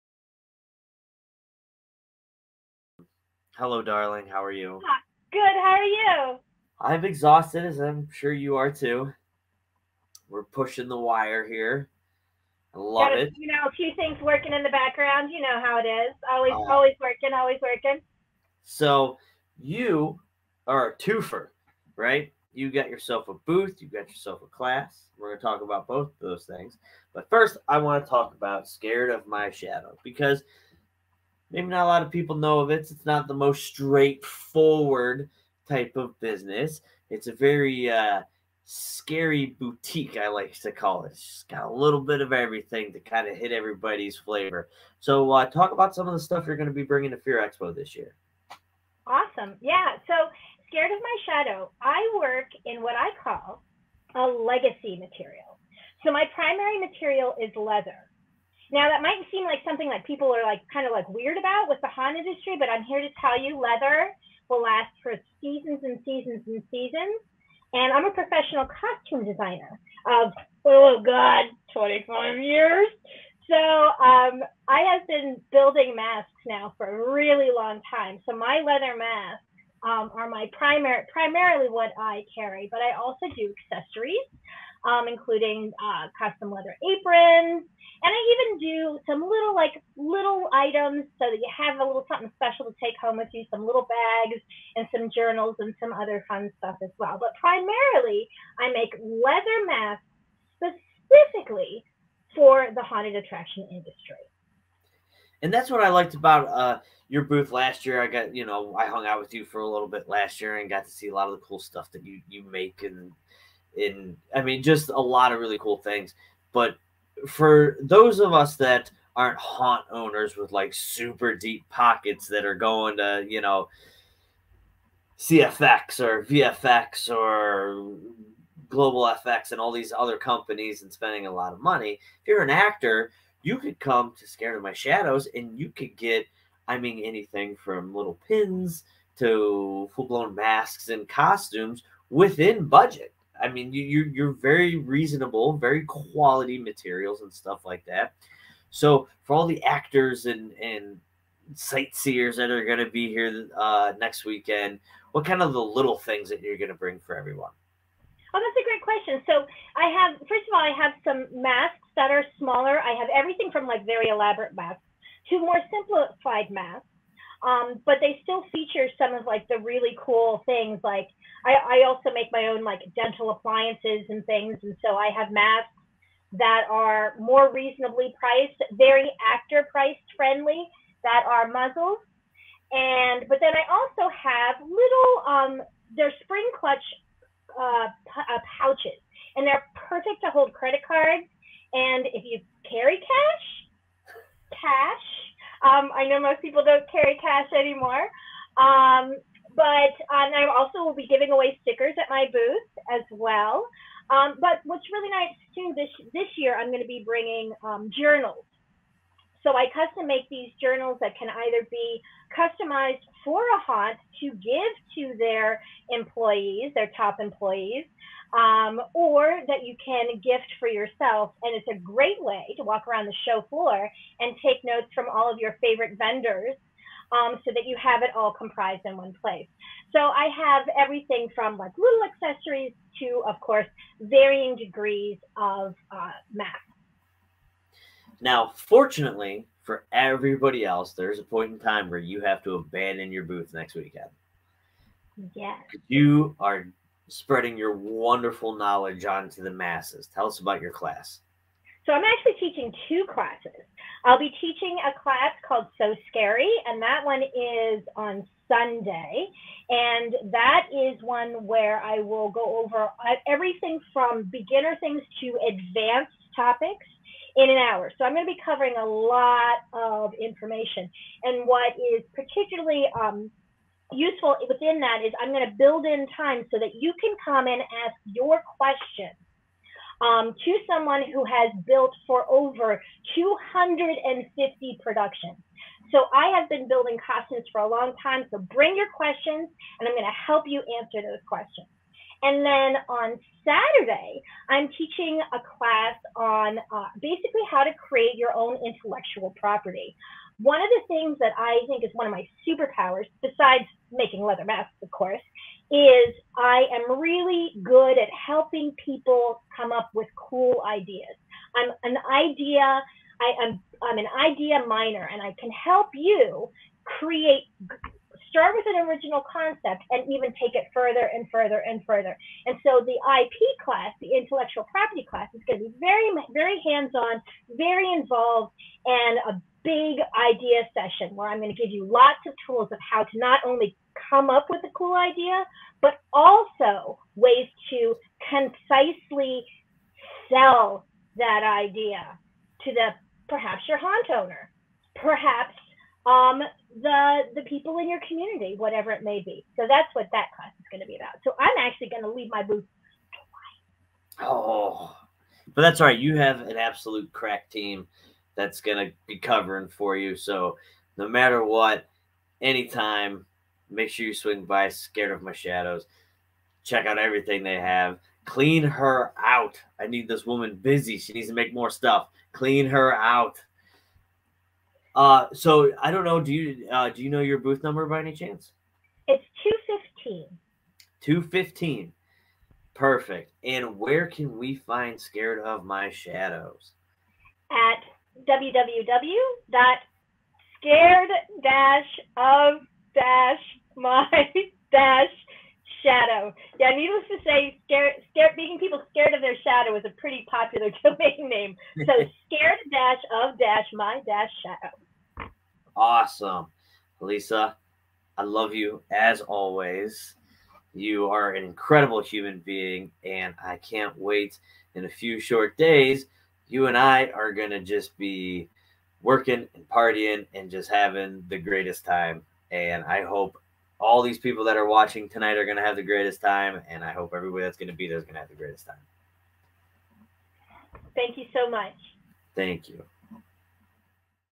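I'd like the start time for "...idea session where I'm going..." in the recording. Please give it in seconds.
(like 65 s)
330 s.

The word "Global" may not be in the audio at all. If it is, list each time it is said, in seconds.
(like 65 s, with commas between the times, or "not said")
128 s.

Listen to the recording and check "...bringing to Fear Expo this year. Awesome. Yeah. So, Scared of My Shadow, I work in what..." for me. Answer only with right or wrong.
right.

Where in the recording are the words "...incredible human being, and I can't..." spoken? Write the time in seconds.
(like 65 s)
411 s.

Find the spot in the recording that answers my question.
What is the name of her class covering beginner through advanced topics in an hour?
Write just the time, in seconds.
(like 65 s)
255 s.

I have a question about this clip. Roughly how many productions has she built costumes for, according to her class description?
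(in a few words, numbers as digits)
Over 250.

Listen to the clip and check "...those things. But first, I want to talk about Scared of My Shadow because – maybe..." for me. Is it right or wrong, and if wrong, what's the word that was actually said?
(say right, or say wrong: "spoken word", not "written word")
right.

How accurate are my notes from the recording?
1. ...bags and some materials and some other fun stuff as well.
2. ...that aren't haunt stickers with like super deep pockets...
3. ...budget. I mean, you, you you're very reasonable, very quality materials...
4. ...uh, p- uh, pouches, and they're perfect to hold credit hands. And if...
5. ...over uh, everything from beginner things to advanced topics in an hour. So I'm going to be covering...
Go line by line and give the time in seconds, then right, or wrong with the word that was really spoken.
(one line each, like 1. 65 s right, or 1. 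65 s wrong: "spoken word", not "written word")
1. 93 s wrong: "journals", not "materials"
2. 118 s wrong: "owners", not "stickers"
3. 142 s right
4. 187 s wrong: "cards", not "hands"
5. 262 s right.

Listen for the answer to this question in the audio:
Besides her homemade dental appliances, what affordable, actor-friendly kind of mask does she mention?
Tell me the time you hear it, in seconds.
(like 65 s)
181 s.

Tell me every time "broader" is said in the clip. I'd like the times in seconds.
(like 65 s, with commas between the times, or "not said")
not said.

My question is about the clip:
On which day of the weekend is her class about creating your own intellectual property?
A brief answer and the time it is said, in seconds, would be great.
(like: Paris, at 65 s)
Saturday, at 293 s.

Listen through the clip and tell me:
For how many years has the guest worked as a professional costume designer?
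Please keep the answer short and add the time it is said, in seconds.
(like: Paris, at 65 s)
25, at 71 s.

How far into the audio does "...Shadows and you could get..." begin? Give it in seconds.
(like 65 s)
134 s.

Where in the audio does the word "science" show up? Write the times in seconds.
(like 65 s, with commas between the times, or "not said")
not said.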